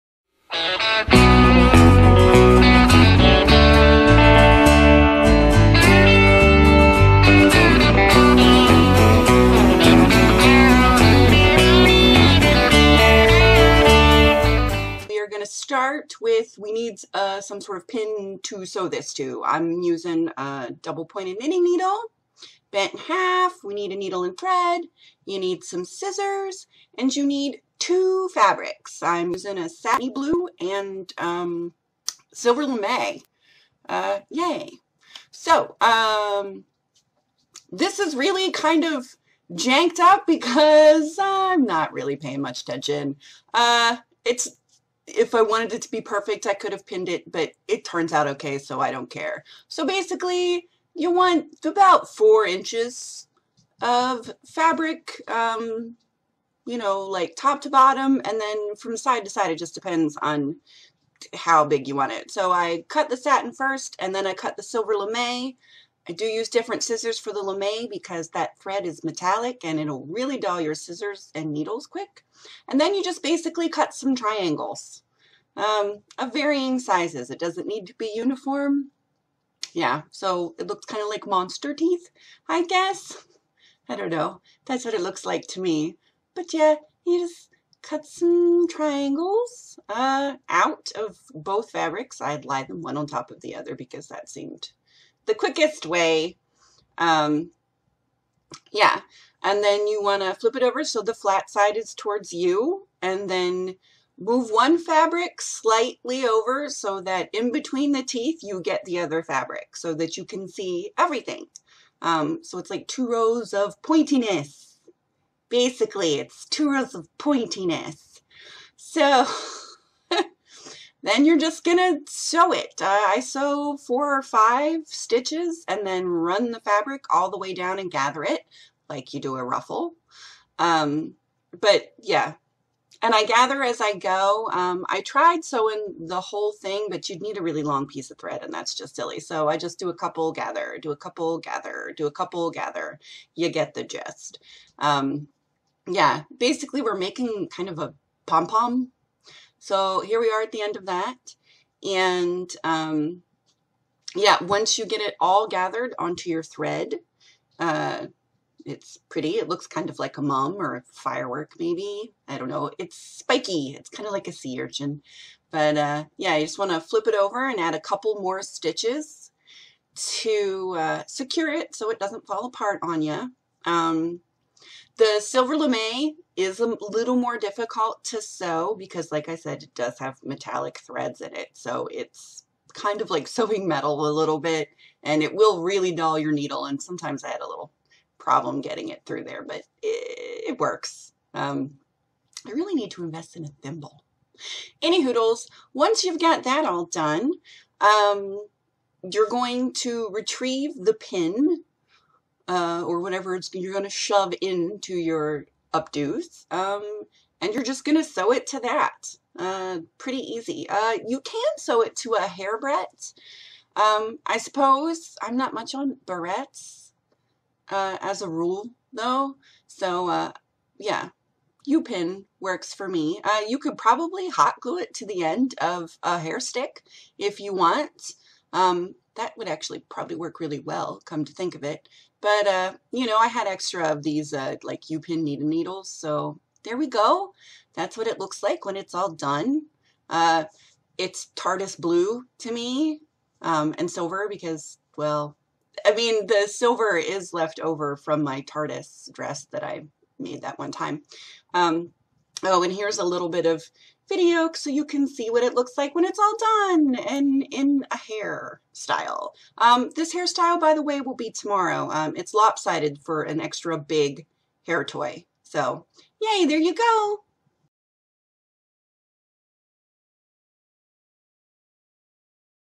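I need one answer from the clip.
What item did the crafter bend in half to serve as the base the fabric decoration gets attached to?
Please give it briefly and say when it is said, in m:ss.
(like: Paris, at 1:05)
double pointed knitting needle, at 0:20.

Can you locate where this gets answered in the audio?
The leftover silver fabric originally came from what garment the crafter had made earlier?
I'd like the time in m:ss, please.
4:08.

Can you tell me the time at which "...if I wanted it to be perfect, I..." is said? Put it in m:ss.
0:45.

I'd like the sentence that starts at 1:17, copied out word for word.
It doesn't need to be uniform.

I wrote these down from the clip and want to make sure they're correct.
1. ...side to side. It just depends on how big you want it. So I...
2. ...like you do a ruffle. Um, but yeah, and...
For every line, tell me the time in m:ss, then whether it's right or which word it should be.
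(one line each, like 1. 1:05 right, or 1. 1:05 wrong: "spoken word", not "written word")
1. 0:58 right
2. 2:08 right.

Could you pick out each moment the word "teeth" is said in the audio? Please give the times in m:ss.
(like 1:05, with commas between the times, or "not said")
1:21, 1:48.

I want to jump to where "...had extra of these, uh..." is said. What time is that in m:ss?
3:53.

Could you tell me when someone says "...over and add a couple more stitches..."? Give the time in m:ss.
2:47.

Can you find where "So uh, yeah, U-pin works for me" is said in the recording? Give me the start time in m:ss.
3:39.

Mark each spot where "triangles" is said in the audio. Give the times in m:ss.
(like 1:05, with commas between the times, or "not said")
1:14, 1:28.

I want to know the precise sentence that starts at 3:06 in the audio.
And sometimes I had a little problem getting it through there, but it, it works.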